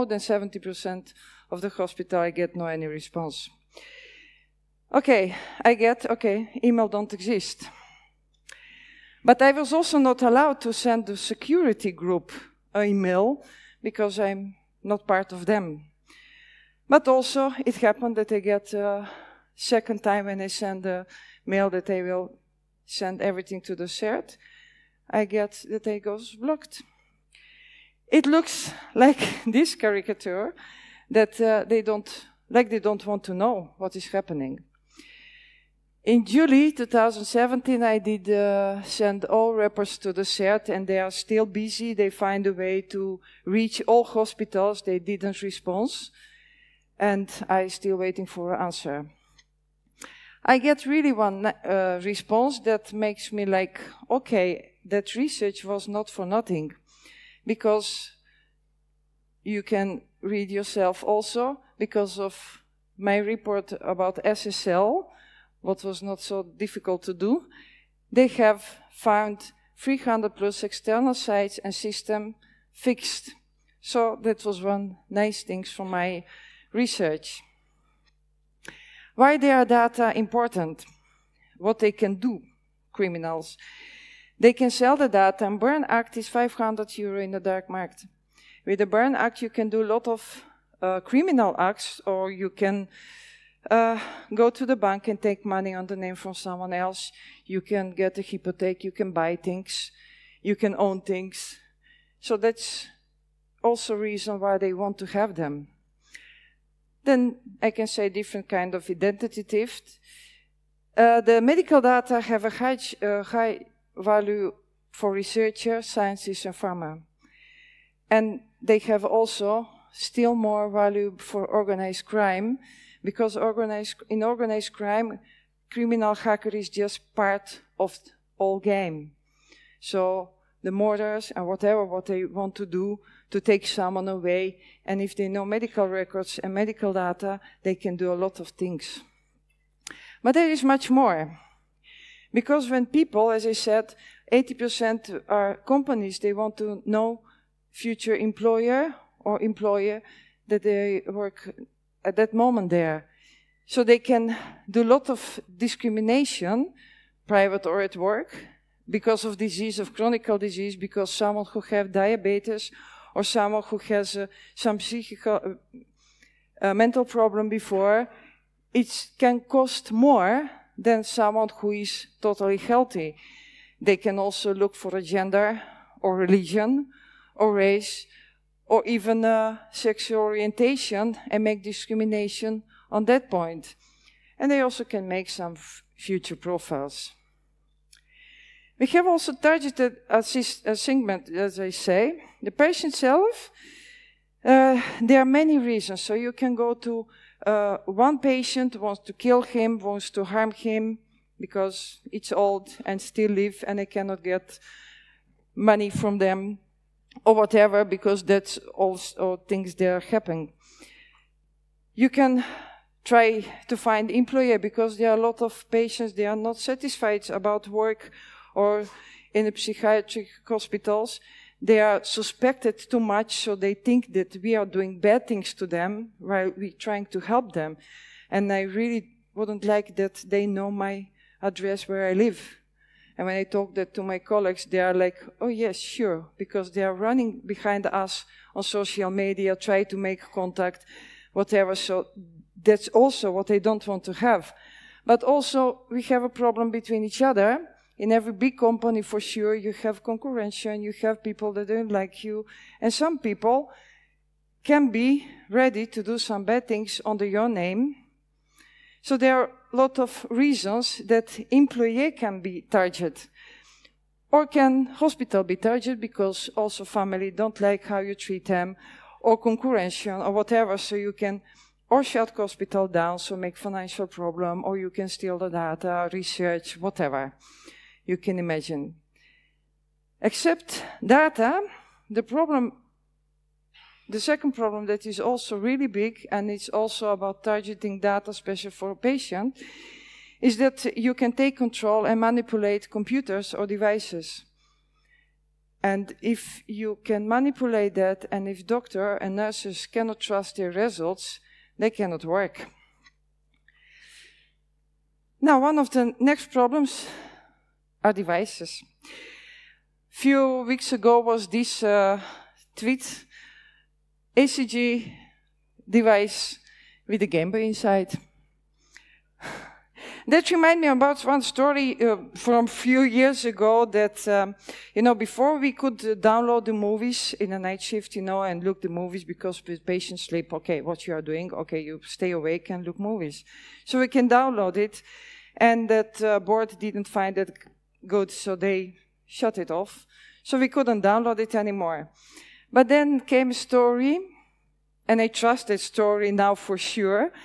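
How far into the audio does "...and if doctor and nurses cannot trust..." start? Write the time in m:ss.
4:58.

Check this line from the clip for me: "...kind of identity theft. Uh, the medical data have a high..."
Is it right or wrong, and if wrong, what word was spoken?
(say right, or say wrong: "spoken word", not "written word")
right.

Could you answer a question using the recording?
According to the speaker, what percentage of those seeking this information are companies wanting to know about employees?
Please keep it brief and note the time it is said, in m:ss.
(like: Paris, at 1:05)
80%, at 2:24.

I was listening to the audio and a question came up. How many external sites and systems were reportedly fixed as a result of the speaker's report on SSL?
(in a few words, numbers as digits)
300 plus.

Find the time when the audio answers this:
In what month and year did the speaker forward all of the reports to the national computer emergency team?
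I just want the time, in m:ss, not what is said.
0:36.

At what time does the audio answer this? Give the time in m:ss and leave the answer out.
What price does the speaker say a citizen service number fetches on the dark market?
1:26.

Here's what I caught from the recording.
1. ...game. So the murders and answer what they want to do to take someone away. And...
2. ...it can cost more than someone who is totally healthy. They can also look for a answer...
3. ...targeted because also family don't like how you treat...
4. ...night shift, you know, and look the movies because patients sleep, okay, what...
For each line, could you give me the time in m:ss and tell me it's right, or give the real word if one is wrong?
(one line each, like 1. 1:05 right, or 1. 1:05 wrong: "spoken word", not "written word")
1. 2:08 wrong: "whatever", not "answer"
2. 2:48 wrong: "gender", not "answer"
3. 4:25 right
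4. 5:27 right.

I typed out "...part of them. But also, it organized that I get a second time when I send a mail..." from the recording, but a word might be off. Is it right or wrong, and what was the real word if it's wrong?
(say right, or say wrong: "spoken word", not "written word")
wrong: "happened", not "organized".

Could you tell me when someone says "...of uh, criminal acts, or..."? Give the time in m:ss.
1:30.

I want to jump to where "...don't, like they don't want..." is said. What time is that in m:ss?
0:31.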